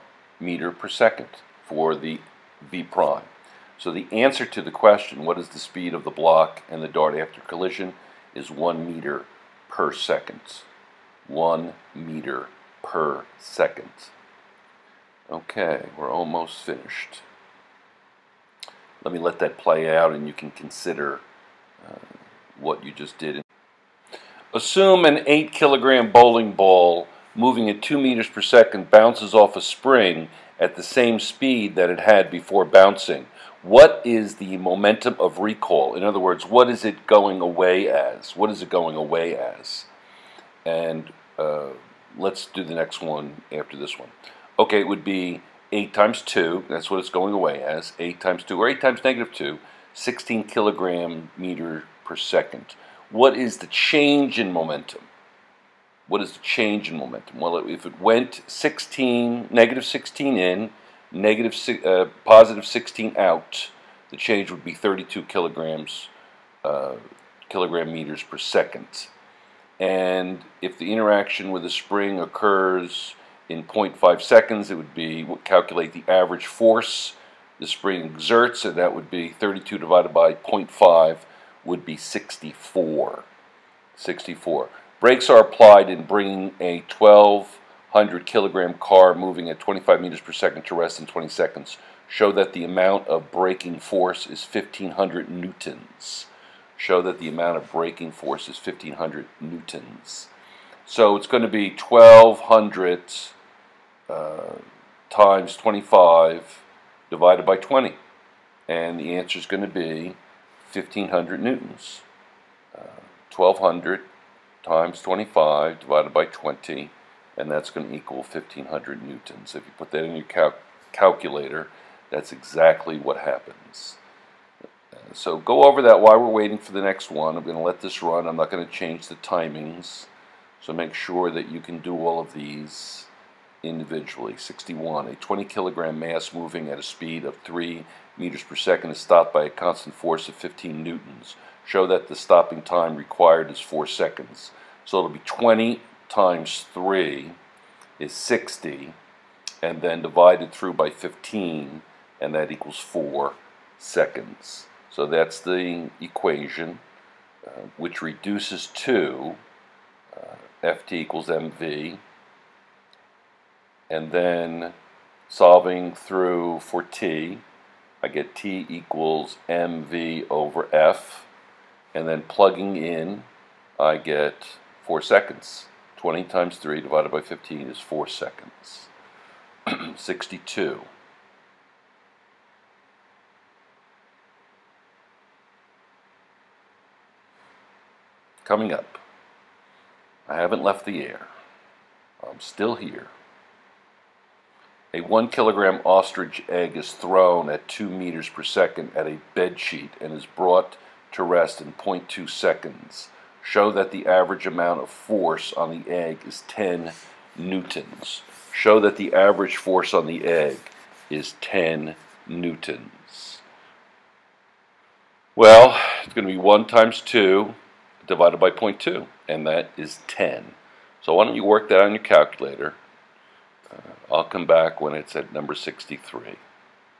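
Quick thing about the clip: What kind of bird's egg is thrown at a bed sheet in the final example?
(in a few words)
ostrich.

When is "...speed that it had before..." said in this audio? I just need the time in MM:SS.
00:31.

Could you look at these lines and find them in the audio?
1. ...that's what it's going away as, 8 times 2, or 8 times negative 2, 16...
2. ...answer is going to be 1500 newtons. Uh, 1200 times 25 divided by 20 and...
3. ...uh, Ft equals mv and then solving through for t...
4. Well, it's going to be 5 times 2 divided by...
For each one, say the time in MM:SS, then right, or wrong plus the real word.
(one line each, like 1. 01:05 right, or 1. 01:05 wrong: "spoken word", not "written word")
1. 00:46 right
2. 01:49 right
3. 02:40 right
4. 03:35 wrong: "1", not "5".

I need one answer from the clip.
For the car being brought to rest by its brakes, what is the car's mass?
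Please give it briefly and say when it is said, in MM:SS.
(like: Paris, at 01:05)
1,200 kilograms, at 01:26.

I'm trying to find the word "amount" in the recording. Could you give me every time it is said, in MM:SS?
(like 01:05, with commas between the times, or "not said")
01:32, 01:37, 03:24.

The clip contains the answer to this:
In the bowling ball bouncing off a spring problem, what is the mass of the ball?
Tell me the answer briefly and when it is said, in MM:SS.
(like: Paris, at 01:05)
8 kilograms, at 00:25.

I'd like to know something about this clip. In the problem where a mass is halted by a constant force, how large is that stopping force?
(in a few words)
15 newtons.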